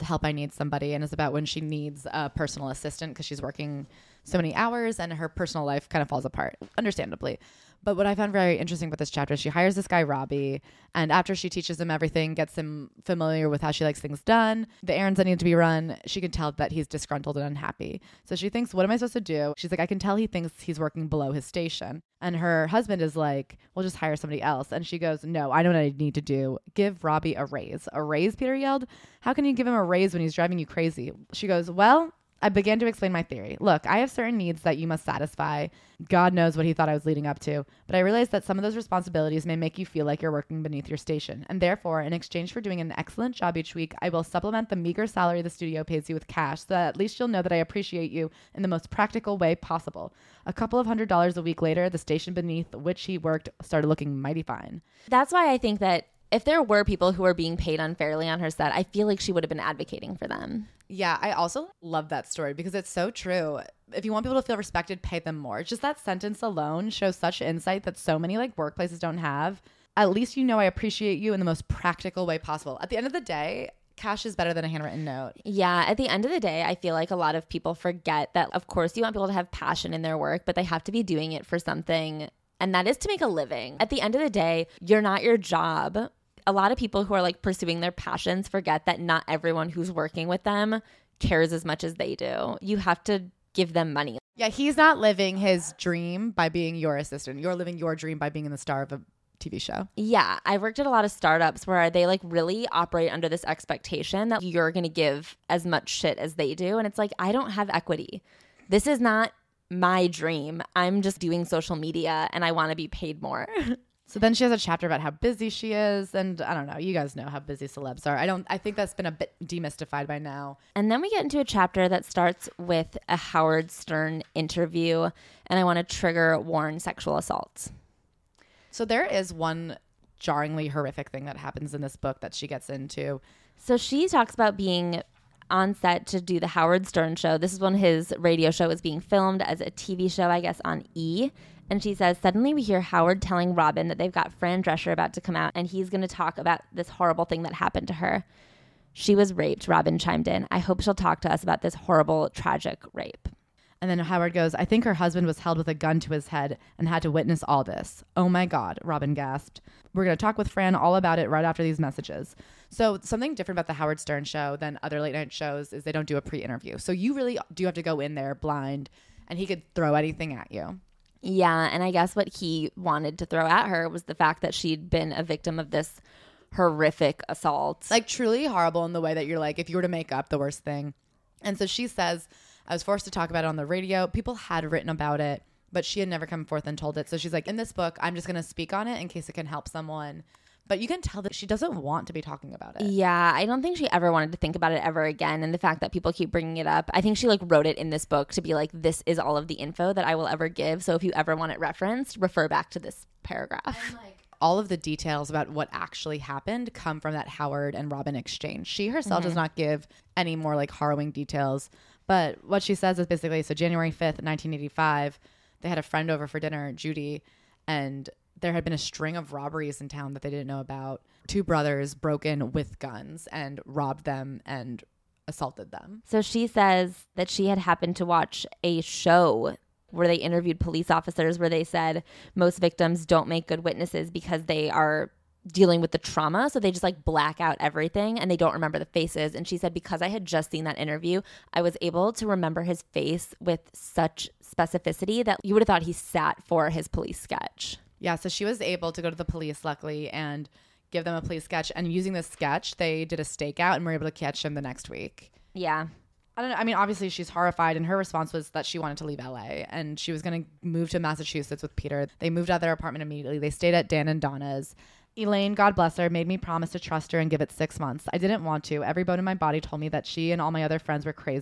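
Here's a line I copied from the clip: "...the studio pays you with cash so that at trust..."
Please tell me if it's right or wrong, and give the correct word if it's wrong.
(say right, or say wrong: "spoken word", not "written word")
wrong: "least", not "trust".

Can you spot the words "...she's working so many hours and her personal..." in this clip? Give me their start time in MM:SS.
00:03.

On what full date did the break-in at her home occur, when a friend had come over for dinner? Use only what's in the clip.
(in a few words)
January 5, 1985.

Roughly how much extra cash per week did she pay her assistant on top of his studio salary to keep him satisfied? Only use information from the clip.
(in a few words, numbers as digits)
A couple of hundred dollars.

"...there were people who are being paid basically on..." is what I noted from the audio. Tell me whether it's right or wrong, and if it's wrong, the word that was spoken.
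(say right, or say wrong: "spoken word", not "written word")
wrong: "unfairly", not "basically".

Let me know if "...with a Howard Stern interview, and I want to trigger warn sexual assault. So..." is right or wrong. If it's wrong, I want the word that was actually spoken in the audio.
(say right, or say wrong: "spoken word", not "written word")
right.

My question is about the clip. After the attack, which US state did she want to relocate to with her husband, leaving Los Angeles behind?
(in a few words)
Massachusetts.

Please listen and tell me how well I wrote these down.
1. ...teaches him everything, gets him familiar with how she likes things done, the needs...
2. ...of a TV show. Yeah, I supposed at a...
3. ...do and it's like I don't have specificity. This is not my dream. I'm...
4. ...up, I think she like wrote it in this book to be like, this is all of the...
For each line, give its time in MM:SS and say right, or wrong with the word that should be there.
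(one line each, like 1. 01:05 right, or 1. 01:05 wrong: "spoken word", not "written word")
1. 00:11 wrong: "errands", not "needs"
2. 01:38 wrong: "worked", not "supposed"
3. 01:46 wrong: "equity", not "specificity"
4. 03:16 right.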